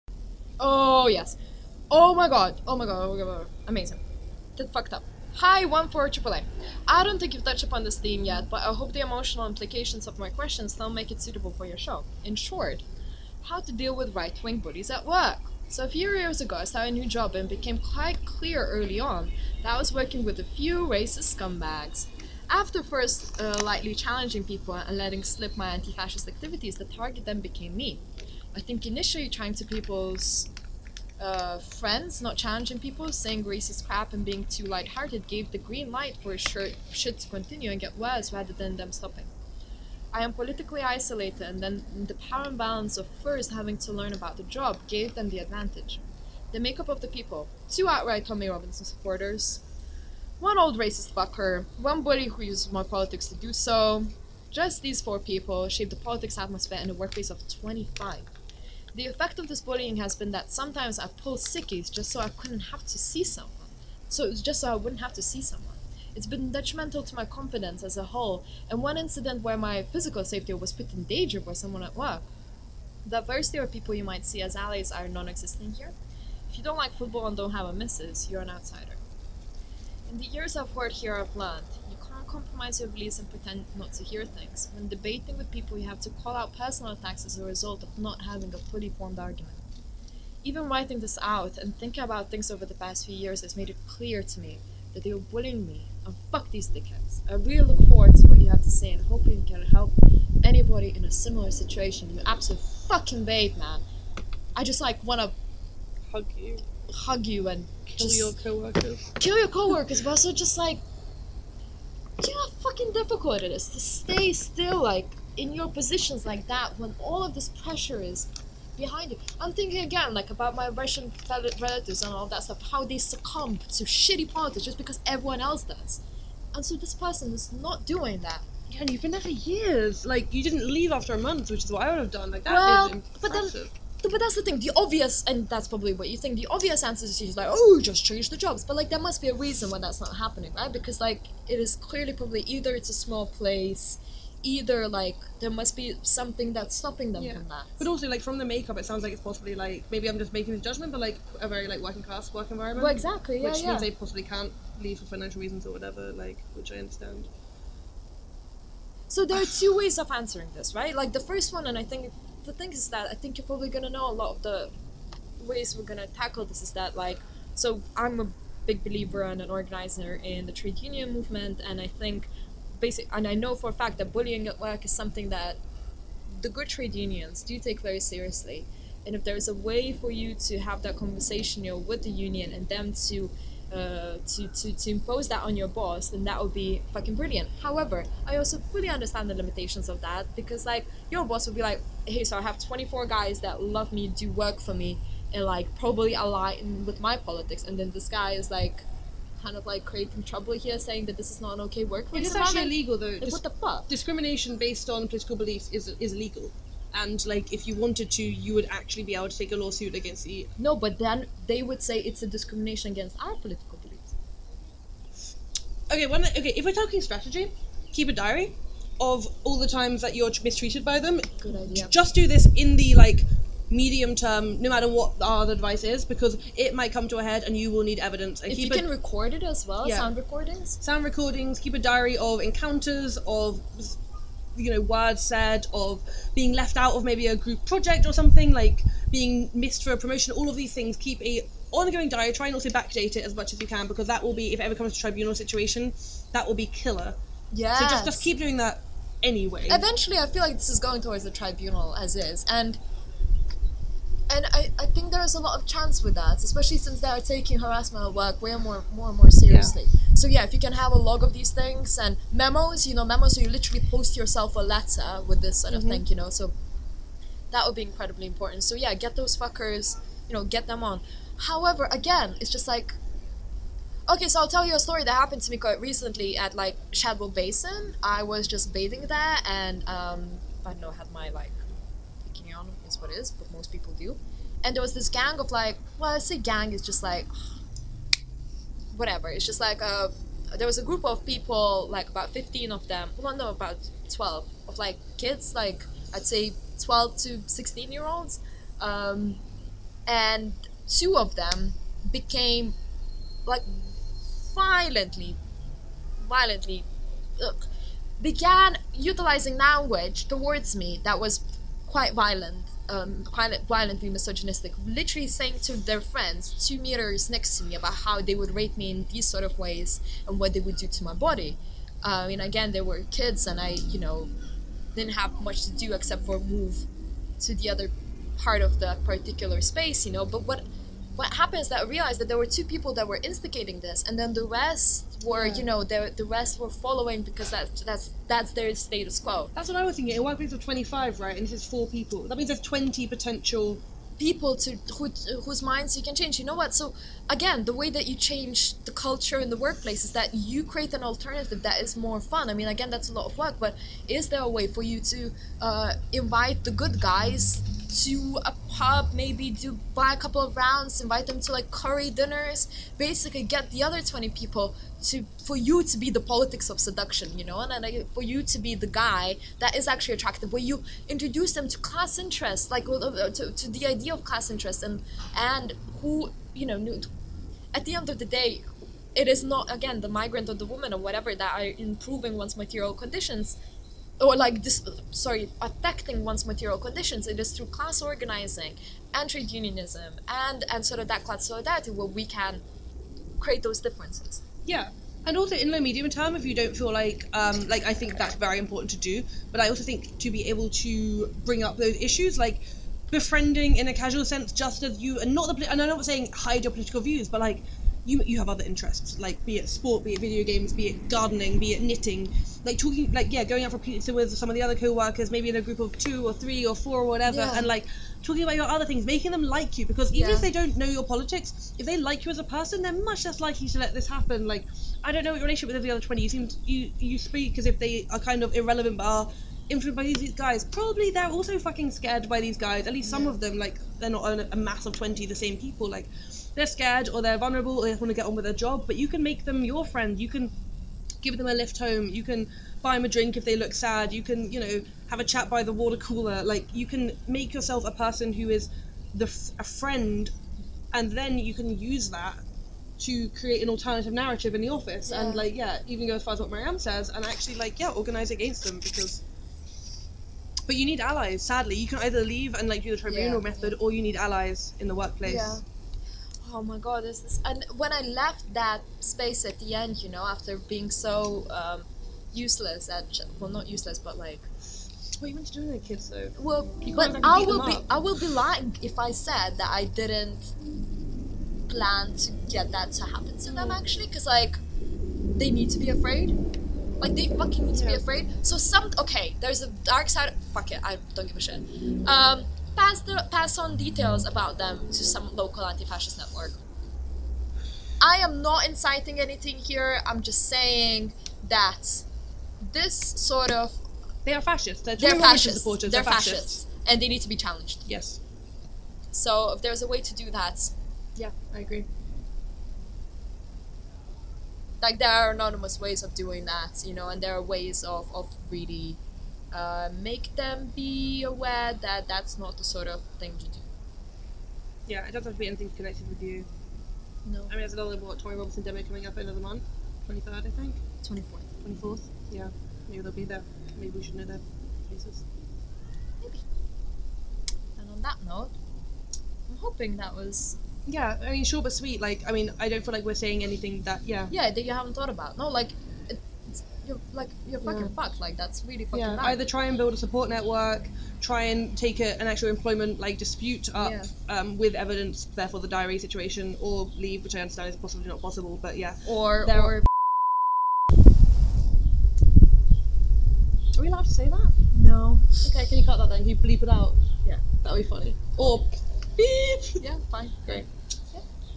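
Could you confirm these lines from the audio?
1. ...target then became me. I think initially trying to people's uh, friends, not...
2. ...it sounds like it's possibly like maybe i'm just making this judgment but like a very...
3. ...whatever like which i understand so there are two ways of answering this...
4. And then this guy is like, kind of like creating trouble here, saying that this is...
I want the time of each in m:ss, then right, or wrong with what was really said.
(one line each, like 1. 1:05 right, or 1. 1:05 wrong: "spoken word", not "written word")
1. 0:26 right
2. 2:28 right
3. 2:35 right
4. 3:17 right.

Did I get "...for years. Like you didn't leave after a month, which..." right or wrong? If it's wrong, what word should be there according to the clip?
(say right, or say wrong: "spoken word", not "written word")
right.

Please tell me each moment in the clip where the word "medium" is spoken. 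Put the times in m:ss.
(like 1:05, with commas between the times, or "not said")
3:43, 6:35.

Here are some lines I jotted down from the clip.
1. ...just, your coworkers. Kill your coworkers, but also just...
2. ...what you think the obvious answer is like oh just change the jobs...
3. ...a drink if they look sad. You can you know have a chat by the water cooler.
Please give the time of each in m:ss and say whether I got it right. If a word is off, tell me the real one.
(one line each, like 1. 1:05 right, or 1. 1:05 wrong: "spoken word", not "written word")
1. 1:48 right
2. 2:15 right
3. 7:23 right.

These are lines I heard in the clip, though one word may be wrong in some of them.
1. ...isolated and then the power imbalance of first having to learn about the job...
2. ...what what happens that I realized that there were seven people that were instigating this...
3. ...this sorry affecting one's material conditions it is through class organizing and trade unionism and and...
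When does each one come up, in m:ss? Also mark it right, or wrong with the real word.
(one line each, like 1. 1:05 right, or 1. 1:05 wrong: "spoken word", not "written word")
1. 0:40 right
2. 5:30 wrong: "two", not "seven"
3. 6:24 right.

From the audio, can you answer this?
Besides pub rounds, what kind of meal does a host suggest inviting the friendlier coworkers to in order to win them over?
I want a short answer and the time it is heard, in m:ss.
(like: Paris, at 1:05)
Curry dinners, at 6:01.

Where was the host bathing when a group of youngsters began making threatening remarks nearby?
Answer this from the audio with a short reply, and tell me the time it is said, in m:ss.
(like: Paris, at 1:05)
Shadwell Basin, at 4:36.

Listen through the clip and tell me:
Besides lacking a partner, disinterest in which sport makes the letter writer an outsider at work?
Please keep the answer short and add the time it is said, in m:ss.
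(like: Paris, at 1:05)
Football, at 1:16.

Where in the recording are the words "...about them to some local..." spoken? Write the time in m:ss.
8:14.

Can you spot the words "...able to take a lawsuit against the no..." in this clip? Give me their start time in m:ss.
3:29.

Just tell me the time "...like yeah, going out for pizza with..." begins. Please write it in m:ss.
6:53.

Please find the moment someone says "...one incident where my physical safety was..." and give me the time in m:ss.
1:08.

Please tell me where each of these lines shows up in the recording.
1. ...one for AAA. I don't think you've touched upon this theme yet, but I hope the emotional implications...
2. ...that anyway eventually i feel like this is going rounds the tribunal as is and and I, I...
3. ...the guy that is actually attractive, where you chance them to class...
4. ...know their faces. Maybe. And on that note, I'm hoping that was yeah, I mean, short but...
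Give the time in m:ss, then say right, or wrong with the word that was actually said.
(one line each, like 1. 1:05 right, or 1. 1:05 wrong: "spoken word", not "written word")
1. 0:05 right
2. 4:08 wrong: "towards", not "rounds"
3. 6:08 wrong: "introduce", not "chance"
4. 8:54 right.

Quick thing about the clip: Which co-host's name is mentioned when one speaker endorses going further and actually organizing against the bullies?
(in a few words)
Marianne.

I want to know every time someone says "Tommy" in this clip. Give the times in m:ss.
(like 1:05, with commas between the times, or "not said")
0:48, 8:48.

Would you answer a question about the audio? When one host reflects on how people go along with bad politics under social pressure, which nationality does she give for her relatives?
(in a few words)
Russian.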